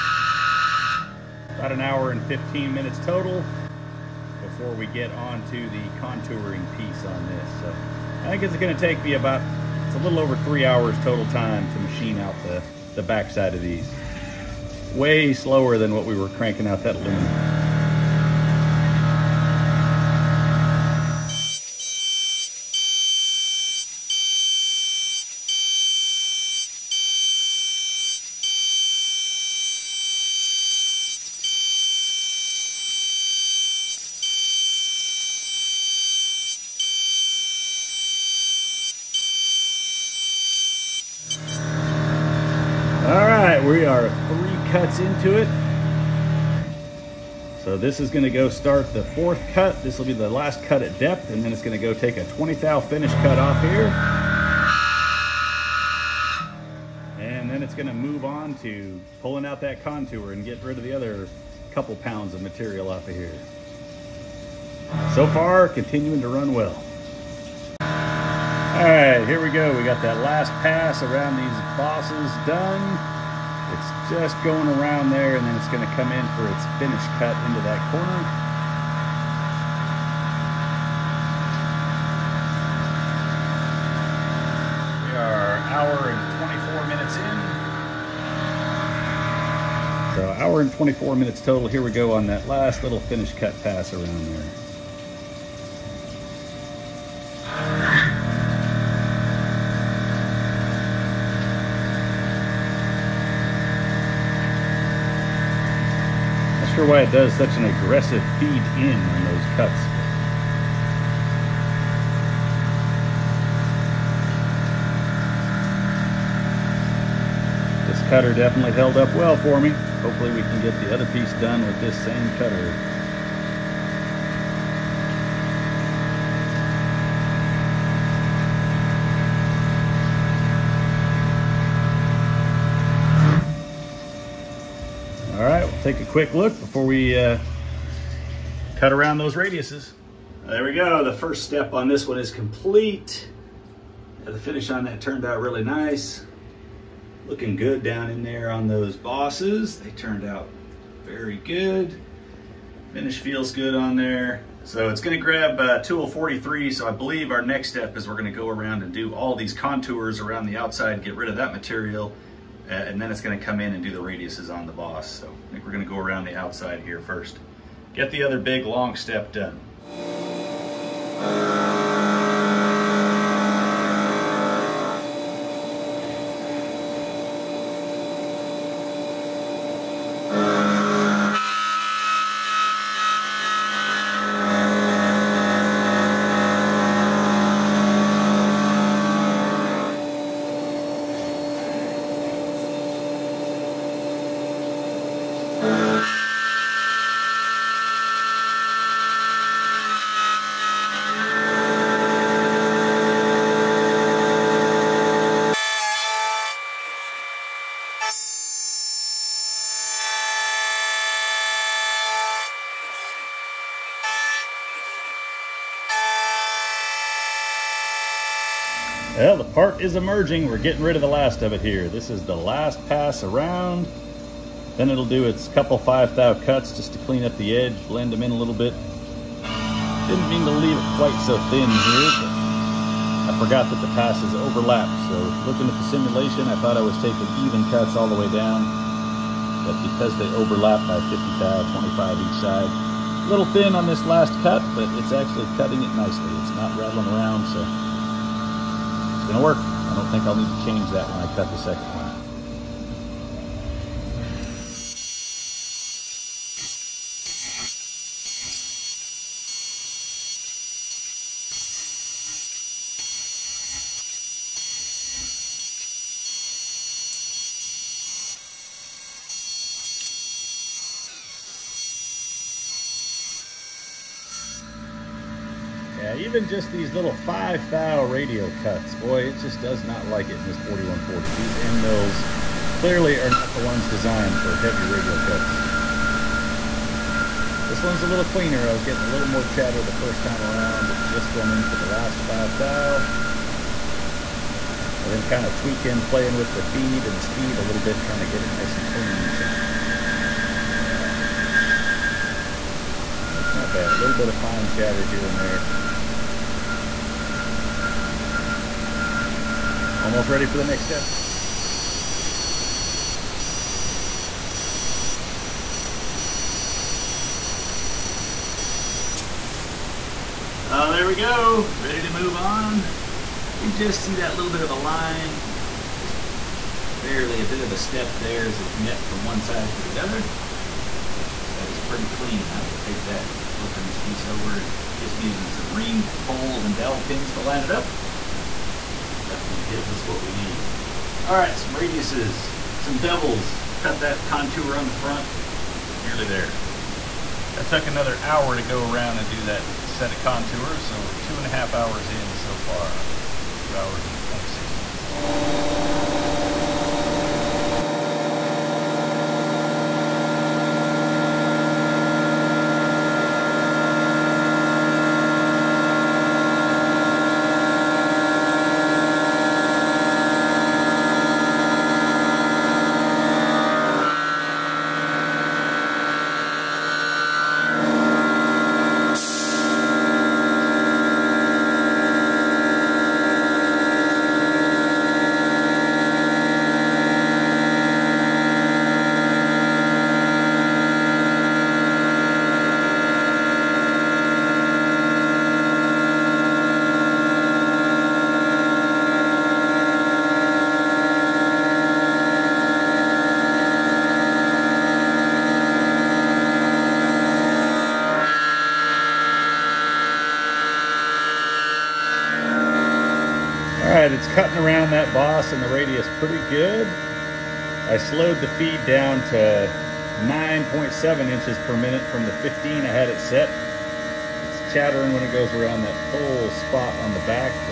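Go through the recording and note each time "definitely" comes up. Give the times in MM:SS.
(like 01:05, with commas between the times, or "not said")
01:58, 05:39.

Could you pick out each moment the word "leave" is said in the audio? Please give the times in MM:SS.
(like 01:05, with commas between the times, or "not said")
03:50.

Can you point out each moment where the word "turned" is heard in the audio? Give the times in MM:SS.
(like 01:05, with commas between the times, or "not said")
02:24, 02:29.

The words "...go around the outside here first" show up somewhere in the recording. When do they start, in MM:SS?
02:45.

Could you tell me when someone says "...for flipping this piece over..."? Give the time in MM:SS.
05:33.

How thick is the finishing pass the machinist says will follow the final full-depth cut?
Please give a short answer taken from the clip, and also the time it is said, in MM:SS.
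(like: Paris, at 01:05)
20 thou, at 00:52.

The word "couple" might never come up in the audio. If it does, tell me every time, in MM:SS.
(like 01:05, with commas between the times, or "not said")
01:01, 03:45.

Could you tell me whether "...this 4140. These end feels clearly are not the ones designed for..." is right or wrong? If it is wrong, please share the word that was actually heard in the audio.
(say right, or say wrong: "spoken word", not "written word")
wrong: "mills", not "feels".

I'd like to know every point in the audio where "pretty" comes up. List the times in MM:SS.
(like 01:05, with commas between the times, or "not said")
05:31, 06:56.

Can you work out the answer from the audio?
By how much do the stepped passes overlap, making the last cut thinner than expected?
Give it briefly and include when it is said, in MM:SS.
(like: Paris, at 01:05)
50 thou, at 04:01.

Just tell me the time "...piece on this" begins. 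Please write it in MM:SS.
00:06.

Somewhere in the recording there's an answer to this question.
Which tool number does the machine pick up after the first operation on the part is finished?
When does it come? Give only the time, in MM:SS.
02:35.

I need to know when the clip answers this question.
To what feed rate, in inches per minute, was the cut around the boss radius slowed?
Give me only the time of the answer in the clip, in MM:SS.
07:00.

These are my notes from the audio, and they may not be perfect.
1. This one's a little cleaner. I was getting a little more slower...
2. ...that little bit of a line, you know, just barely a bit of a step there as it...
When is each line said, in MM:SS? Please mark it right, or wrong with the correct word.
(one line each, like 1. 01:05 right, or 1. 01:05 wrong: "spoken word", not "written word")
1. 04:47 wrong: "chatter", not "slower"
2. 05:24 right.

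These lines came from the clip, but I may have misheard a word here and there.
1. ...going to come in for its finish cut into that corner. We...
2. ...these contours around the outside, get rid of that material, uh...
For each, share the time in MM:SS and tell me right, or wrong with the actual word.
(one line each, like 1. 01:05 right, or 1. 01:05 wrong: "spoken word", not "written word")
1. 01:15 right
2. 02:39 right.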